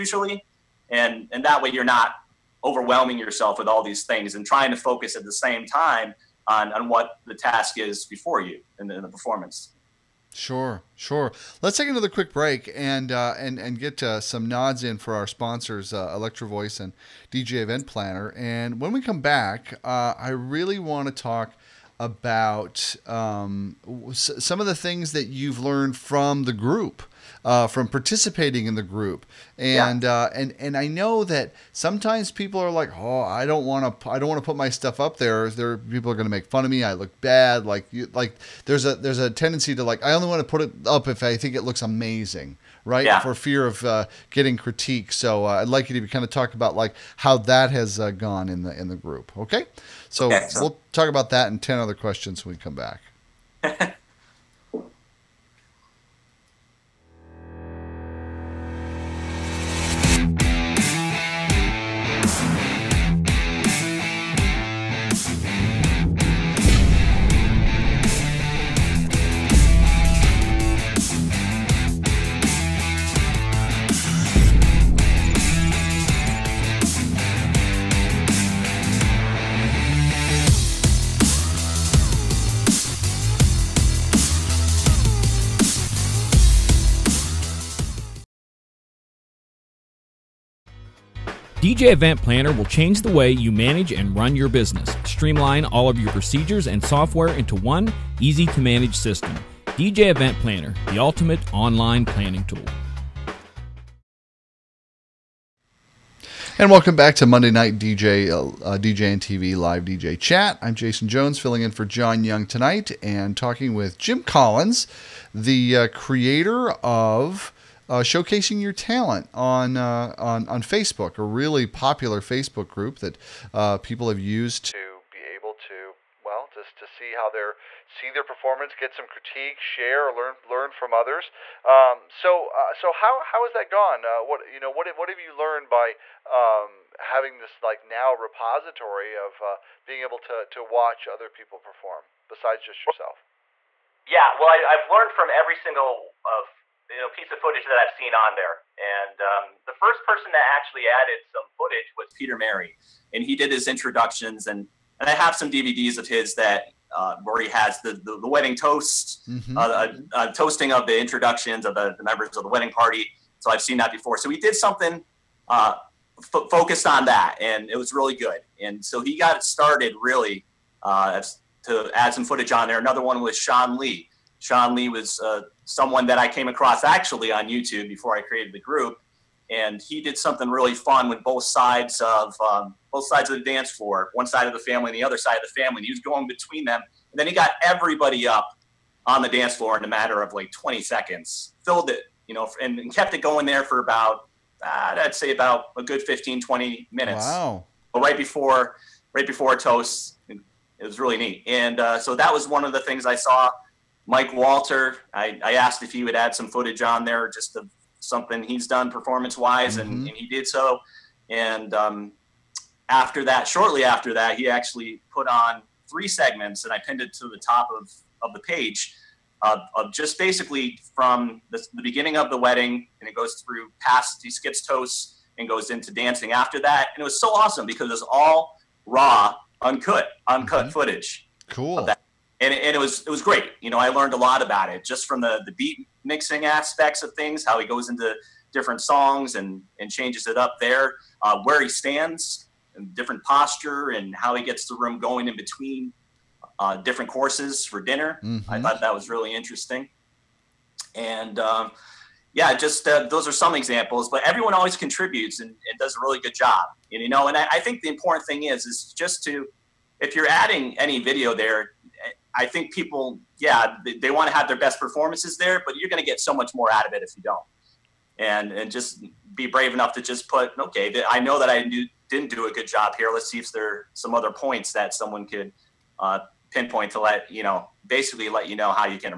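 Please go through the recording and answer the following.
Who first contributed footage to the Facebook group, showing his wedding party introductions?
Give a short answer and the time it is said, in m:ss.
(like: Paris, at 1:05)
Peter Merry, at 2:32.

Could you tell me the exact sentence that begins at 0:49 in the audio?
Okay, so we'll talk about that and ten other questions when we come back.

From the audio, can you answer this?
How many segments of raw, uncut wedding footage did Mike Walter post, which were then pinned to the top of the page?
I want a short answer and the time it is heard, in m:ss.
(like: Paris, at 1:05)
3, at 3:35.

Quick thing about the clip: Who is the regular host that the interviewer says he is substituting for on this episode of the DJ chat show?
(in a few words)
John Young.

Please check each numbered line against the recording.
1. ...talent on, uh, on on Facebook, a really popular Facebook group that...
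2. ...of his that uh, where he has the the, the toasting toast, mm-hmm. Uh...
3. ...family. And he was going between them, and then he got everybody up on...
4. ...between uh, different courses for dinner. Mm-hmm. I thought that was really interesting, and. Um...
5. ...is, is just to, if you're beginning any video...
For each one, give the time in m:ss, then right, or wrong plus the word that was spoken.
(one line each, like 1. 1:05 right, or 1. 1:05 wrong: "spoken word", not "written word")
1. 1:58 right
2. 2:35 wrong: "wedding", not "toasting"
3. 3:05 right
4. 4:05 right
5. 4:18 wrong: "adding", not "beginning".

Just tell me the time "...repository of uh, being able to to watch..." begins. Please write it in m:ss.
2:18.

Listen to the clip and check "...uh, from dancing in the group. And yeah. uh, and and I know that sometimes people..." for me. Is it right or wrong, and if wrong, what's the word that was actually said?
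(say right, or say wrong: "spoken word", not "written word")
wrong: "participating", not "dancing".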